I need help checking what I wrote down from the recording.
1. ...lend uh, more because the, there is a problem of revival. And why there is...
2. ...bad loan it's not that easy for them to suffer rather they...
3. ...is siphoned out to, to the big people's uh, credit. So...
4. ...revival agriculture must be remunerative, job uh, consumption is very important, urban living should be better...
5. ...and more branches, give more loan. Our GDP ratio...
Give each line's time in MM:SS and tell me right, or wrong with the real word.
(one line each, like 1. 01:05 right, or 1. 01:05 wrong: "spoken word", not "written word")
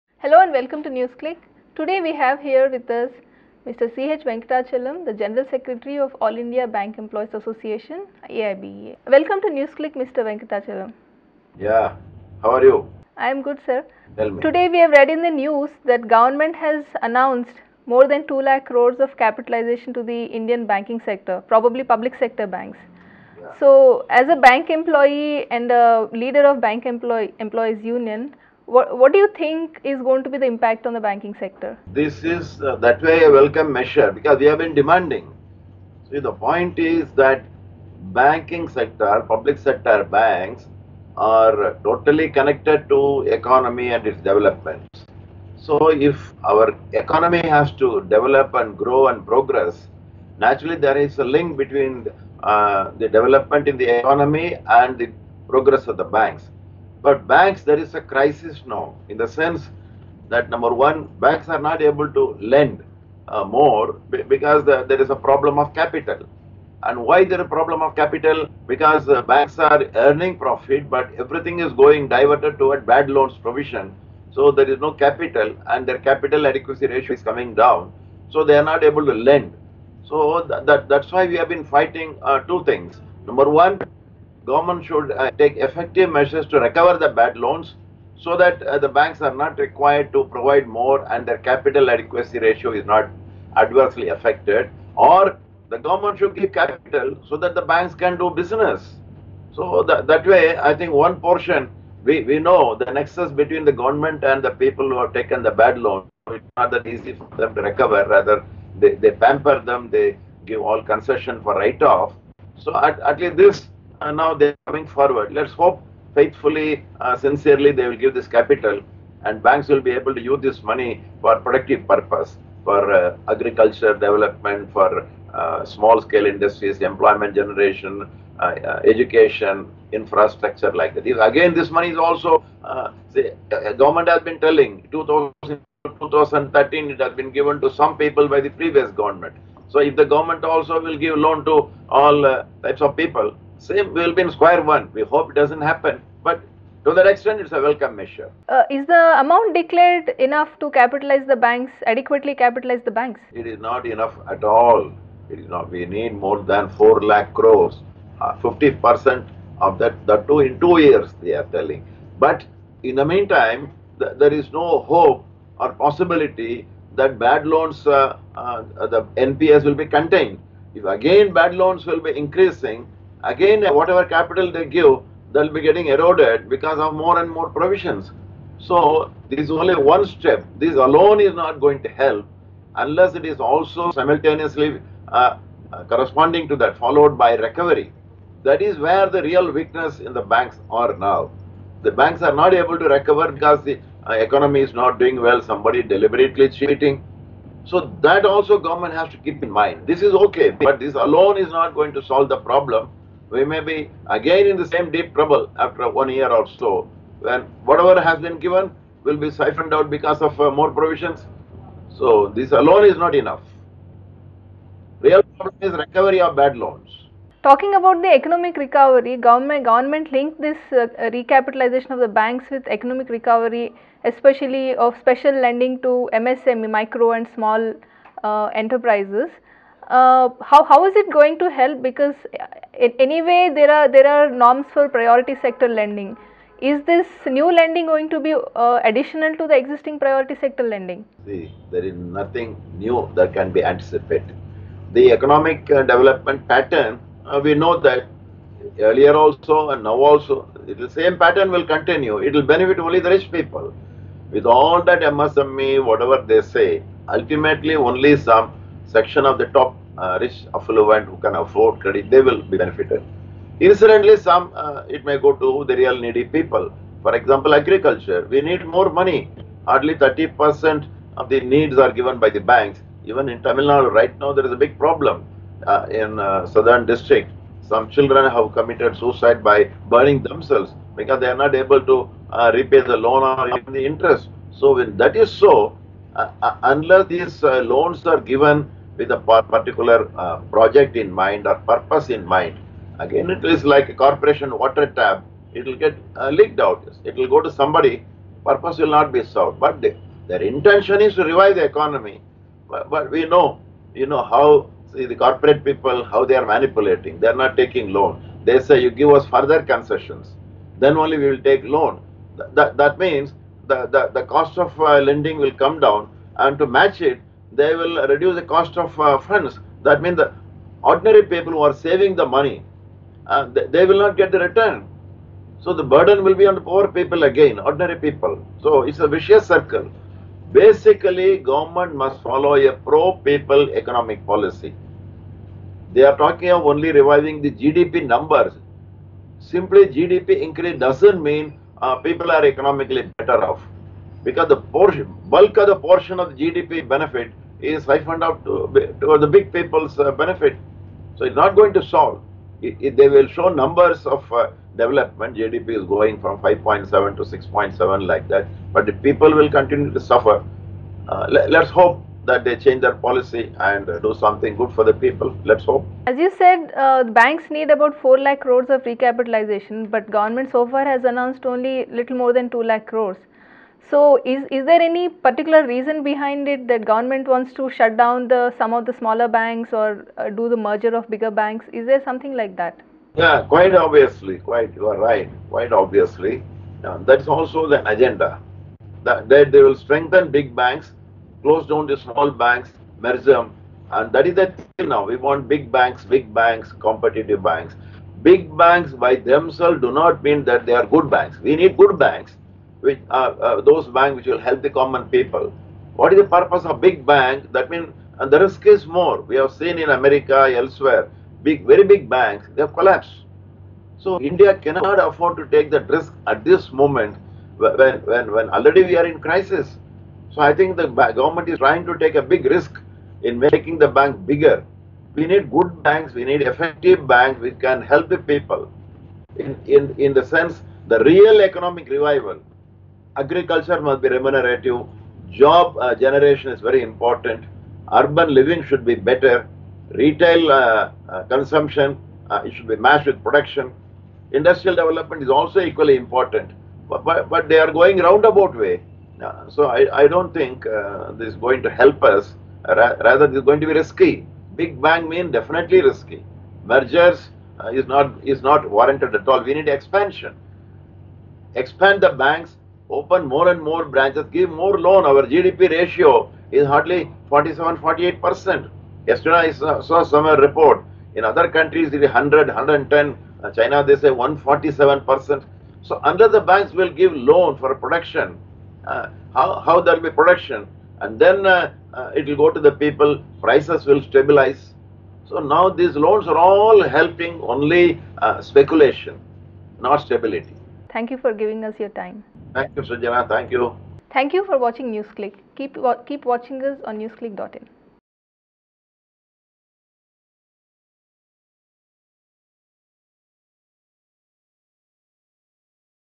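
1. 01:02 wrong: "capital", not "revival"
2. 01:45 wrong: "recover", not "suffer"
3. 05:47 wrong: "benefit", not "credit"
4. 07:11 wrong: "generation", not "consumption"
5. 07:43 right.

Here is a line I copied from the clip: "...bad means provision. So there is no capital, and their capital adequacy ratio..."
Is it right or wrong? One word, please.
wrong.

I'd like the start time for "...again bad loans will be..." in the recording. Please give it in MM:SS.
02:50.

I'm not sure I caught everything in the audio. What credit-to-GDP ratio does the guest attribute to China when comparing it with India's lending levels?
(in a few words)
147%.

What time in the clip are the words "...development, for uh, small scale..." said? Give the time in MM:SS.
02:03.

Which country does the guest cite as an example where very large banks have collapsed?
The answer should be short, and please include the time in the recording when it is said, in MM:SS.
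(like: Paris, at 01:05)
America, at 06:49.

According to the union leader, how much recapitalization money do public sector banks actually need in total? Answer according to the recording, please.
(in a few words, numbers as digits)
more than 4 lakh crores.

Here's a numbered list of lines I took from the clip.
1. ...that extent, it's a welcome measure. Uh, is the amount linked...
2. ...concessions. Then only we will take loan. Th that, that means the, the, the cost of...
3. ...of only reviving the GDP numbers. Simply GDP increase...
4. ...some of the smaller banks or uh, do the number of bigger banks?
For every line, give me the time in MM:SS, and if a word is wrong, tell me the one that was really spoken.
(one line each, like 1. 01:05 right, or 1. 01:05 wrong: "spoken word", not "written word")
1. 02:26 wrong: "declared", not "linked"
2. 05:09 right
3. 05:36 right
4. 06:18 wrong: "merger", not "number".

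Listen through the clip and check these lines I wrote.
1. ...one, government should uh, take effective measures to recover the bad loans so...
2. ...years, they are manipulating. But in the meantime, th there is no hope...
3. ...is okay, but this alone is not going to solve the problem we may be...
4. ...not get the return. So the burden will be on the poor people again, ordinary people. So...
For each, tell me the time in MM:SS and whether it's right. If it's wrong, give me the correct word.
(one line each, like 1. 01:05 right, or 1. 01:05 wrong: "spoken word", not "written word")
1. 01:23 right
2. 02:40 wrong: "telling", not "manipulating"
3. 03:20 right
4. 05:23 right.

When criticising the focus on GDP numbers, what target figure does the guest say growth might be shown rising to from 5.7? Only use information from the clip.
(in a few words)
6.7.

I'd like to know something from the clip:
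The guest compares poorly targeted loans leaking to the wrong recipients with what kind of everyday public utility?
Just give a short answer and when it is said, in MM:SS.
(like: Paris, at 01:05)
corporation water tap, at 04:54.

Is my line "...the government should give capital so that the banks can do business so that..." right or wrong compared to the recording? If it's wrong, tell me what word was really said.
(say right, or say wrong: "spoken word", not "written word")
right.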